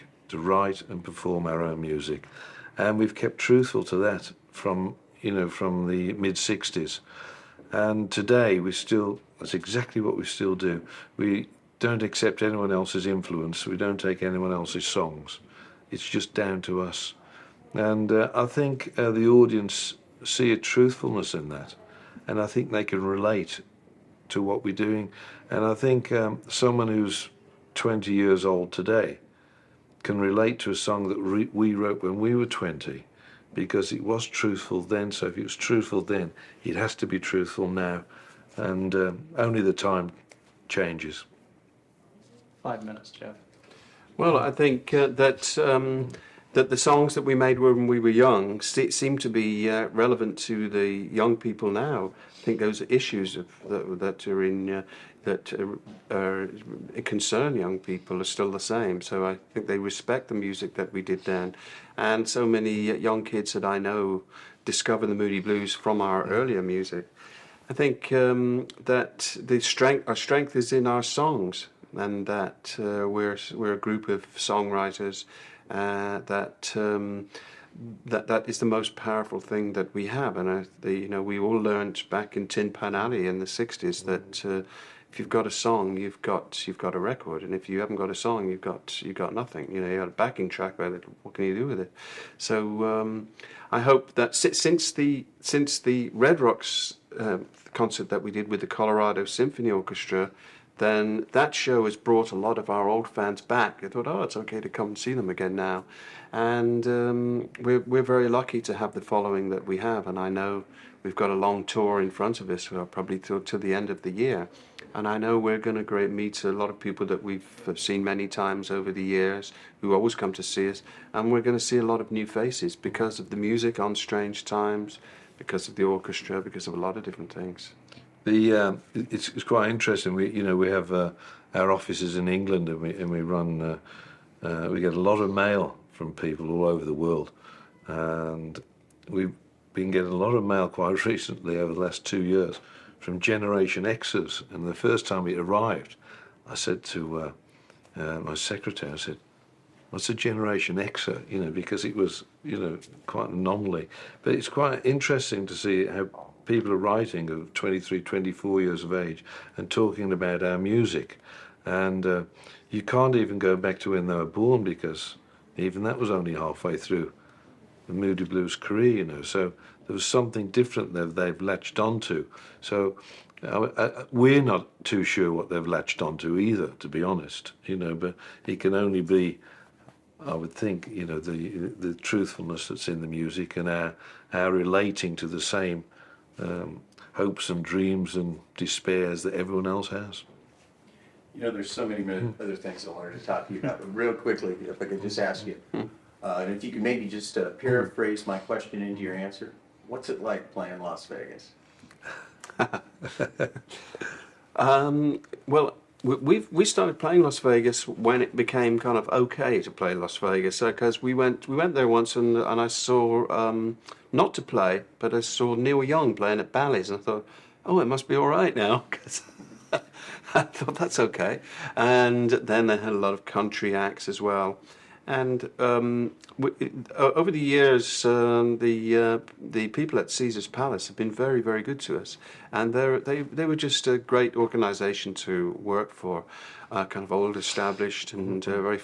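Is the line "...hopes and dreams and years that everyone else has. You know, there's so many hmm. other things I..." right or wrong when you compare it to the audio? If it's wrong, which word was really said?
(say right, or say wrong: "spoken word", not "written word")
wrong: "despairs", not "years".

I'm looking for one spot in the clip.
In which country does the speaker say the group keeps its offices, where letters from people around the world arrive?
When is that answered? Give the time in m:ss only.
2:12.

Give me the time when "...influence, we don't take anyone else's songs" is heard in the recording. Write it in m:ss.
0:13.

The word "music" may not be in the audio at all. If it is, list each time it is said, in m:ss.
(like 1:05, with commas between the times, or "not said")
0:01, 1:00, 1:06, 2:03, 2:40, 3:03.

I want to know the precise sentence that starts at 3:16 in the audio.
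uh, and if you could maybe just uh, hmm.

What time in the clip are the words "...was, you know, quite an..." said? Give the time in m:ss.
2:31.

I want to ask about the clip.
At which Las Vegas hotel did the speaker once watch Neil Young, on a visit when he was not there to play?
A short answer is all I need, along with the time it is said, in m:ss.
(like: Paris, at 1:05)
Bally's, at 3:36.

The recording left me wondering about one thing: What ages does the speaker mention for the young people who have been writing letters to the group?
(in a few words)
23, 24.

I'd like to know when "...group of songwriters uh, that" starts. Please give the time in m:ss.
1:13.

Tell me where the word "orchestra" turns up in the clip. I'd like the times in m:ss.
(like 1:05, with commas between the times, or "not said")
1:39, 2:05.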